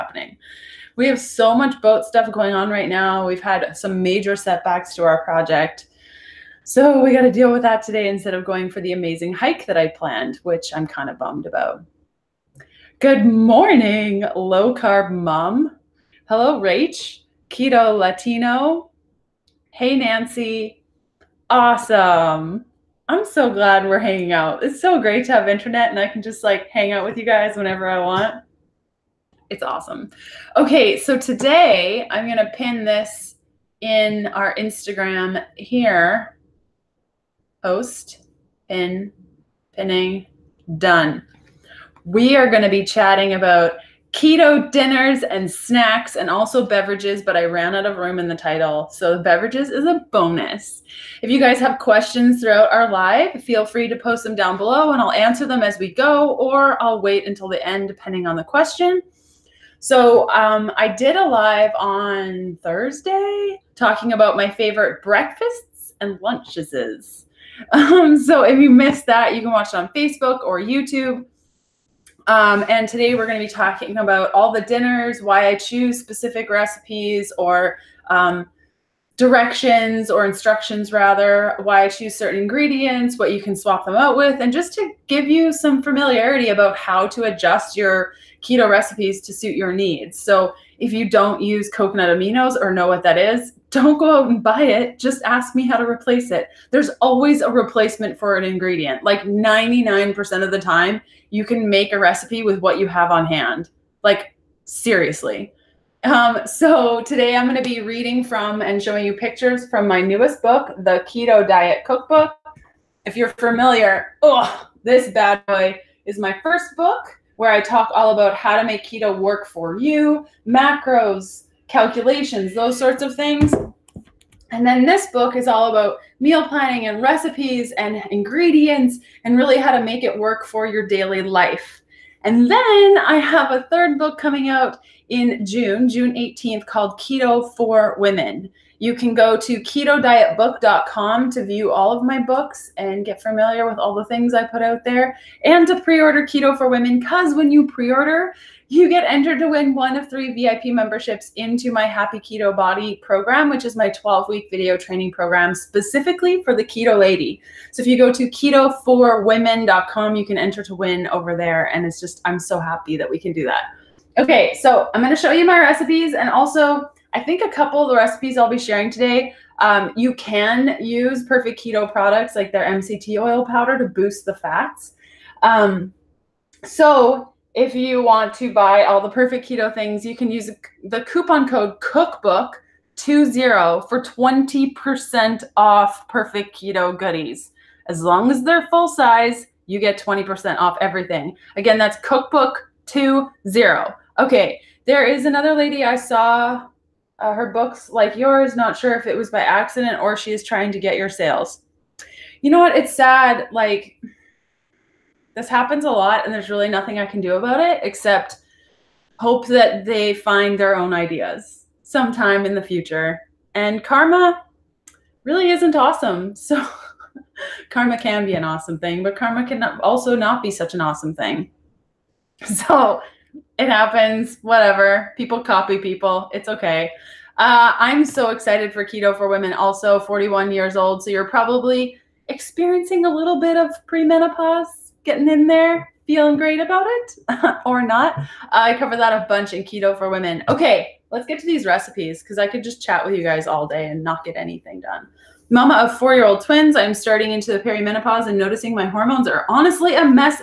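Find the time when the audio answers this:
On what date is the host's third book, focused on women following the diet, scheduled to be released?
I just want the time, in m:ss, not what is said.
2:15.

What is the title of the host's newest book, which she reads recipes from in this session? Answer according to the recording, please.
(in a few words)
The Keto Diet Cookbook.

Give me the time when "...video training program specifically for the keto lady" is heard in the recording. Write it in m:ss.
2:34.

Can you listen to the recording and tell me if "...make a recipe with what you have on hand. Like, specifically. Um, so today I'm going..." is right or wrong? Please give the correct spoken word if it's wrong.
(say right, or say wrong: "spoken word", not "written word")
wrong: "seriously", not "specifically".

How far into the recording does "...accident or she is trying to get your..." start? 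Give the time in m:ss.
3:19.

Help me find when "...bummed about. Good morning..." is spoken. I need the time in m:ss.
0:11.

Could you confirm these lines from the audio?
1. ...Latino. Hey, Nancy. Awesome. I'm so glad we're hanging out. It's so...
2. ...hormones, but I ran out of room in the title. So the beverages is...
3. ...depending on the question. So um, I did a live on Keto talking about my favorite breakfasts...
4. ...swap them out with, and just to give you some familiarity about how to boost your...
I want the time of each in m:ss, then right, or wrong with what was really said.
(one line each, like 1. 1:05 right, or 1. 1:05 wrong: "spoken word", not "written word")
1. 0:17 right
2. 0:46 wrong: "beverages", not "hormones"
3. 0:57 wrong: "Thursday", not "Keto"
4. 1:23 wrong: "adjust", not "boost".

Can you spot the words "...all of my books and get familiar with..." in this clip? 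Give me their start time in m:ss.
2:21.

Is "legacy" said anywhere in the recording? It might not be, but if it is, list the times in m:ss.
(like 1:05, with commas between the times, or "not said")
not said.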